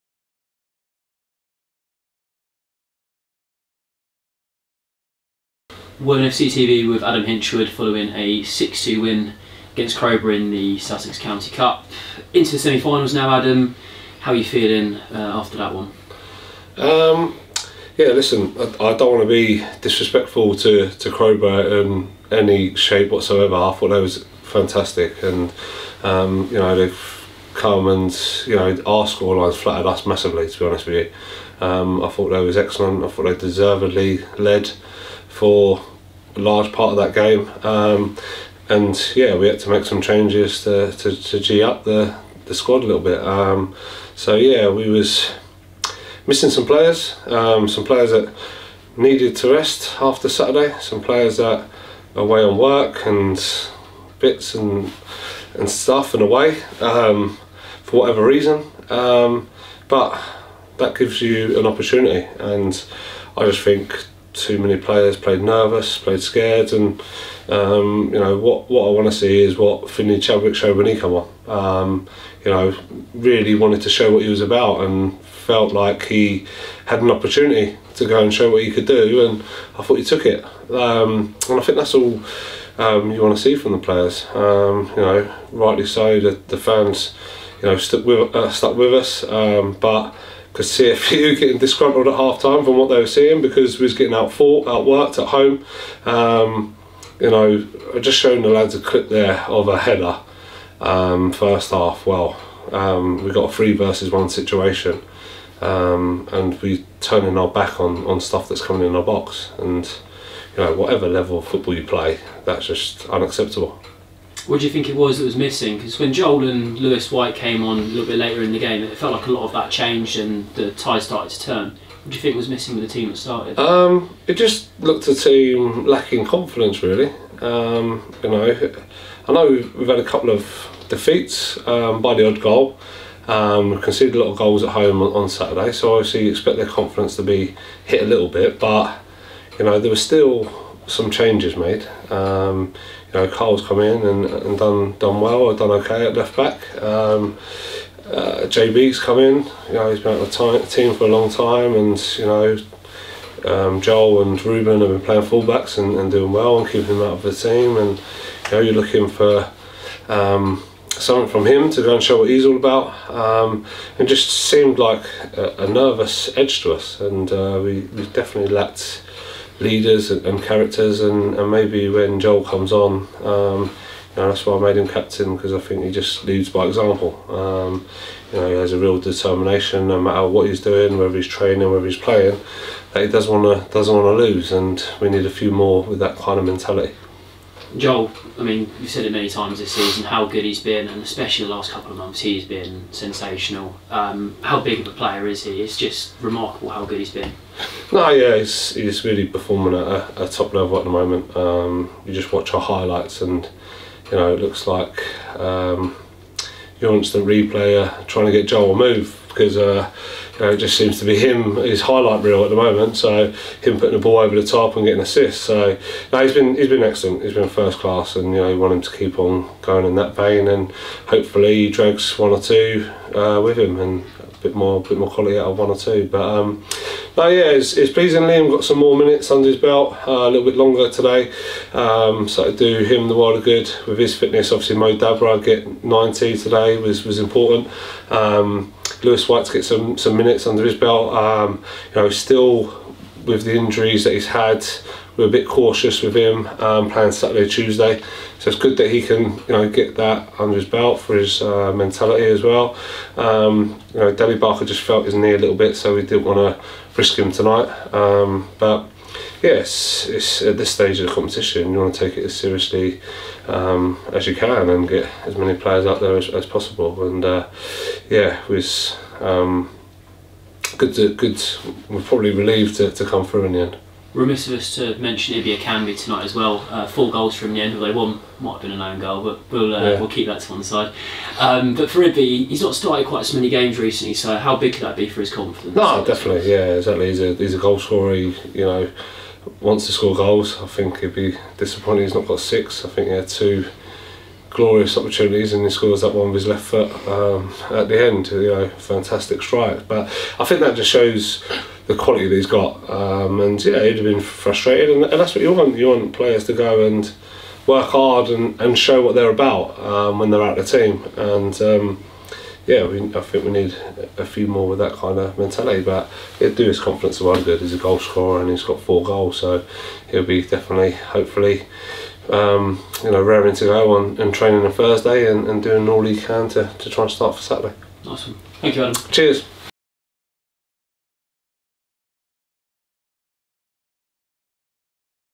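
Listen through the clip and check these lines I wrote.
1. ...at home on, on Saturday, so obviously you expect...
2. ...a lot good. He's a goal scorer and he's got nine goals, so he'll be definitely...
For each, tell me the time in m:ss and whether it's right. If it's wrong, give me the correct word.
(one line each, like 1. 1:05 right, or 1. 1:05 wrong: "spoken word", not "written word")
1. 2:14 right
2. 5:17 wrong: "four", not "nine".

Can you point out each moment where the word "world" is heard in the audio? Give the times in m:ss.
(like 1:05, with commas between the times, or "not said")
3:53.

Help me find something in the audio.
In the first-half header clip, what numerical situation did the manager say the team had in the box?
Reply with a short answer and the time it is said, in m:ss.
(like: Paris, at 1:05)
three versus one, at 1:43.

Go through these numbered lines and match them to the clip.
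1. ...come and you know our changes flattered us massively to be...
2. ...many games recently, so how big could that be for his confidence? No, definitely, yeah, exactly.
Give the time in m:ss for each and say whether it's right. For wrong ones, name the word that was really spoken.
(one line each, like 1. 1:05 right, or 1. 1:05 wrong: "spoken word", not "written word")
1. 0:27 wrong: "scorelines", not "changes"
2. 4:43 right.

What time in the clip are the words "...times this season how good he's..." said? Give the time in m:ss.
3:09.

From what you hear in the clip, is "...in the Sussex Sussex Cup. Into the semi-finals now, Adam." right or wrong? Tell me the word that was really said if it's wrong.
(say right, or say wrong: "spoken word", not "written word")
wrong: "County", not "Sussex".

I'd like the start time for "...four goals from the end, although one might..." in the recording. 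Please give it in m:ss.
4:36.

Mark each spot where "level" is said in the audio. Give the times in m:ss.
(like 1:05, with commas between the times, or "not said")
1:51, 3:20.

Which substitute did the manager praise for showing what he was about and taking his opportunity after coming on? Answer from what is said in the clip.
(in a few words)
Finley Chadwick.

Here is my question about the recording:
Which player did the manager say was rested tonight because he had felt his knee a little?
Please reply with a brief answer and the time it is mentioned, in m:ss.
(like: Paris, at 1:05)
Danny Barker, at 4:14.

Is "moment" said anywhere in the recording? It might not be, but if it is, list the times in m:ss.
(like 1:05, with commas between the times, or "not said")
3:20, 3:32.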